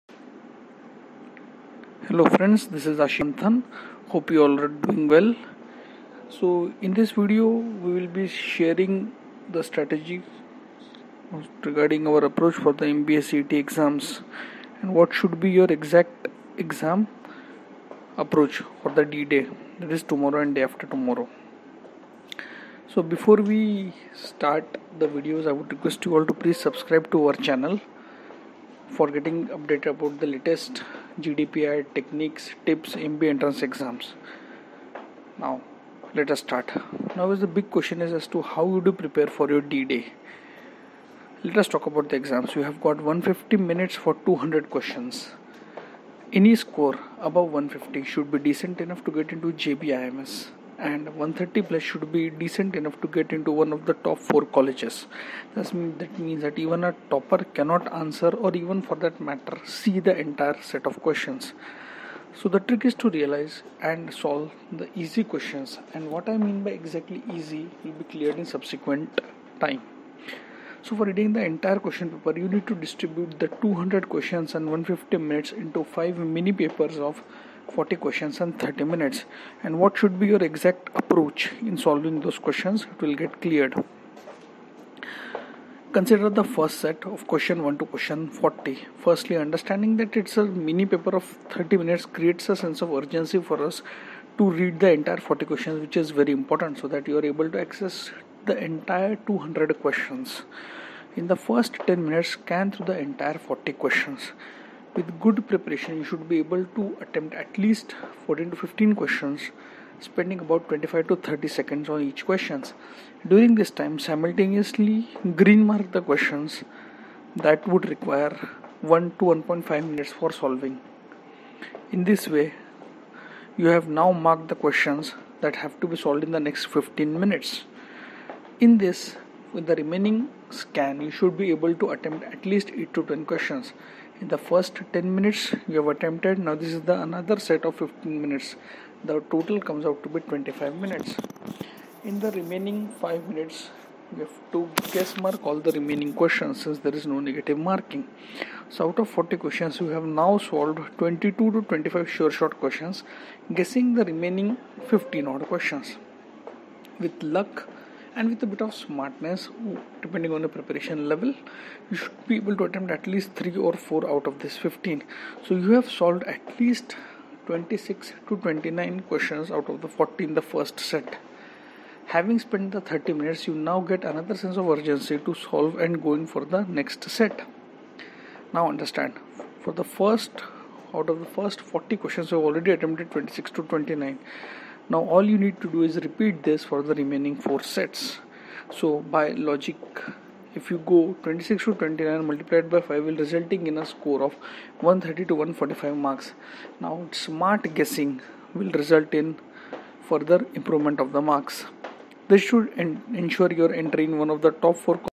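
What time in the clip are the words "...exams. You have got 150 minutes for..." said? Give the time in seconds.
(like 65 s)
42 s.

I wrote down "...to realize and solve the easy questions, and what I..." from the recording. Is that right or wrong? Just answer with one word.
right.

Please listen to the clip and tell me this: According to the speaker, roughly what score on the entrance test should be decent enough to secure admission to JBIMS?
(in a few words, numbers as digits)
above 150.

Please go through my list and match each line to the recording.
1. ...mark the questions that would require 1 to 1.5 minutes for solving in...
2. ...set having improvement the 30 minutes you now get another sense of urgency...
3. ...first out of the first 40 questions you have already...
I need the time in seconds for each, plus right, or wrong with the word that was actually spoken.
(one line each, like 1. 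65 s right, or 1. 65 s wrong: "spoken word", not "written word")
1. 115 s right
2. 170 s wrong: "spent", not "improvement"
3. 179 s right.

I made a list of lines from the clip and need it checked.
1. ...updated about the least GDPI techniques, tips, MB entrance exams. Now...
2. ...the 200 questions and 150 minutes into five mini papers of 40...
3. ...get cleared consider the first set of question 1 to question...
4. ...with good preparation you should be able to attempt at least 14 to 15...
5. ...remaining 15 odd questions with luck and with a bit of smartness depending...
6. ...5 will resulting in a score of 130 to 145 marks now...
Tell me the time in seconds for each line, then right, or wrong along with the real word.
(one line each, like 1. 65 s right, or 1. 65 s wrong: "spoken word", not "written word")
1. 29 s wrong: "latest", not "least"
2. 73 s right
3. 83 s right
4. 104 s right
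5. 154 s right
6. 192 s right.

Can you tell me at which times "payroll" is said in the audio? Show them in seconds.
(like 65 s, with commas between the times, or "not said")
not said.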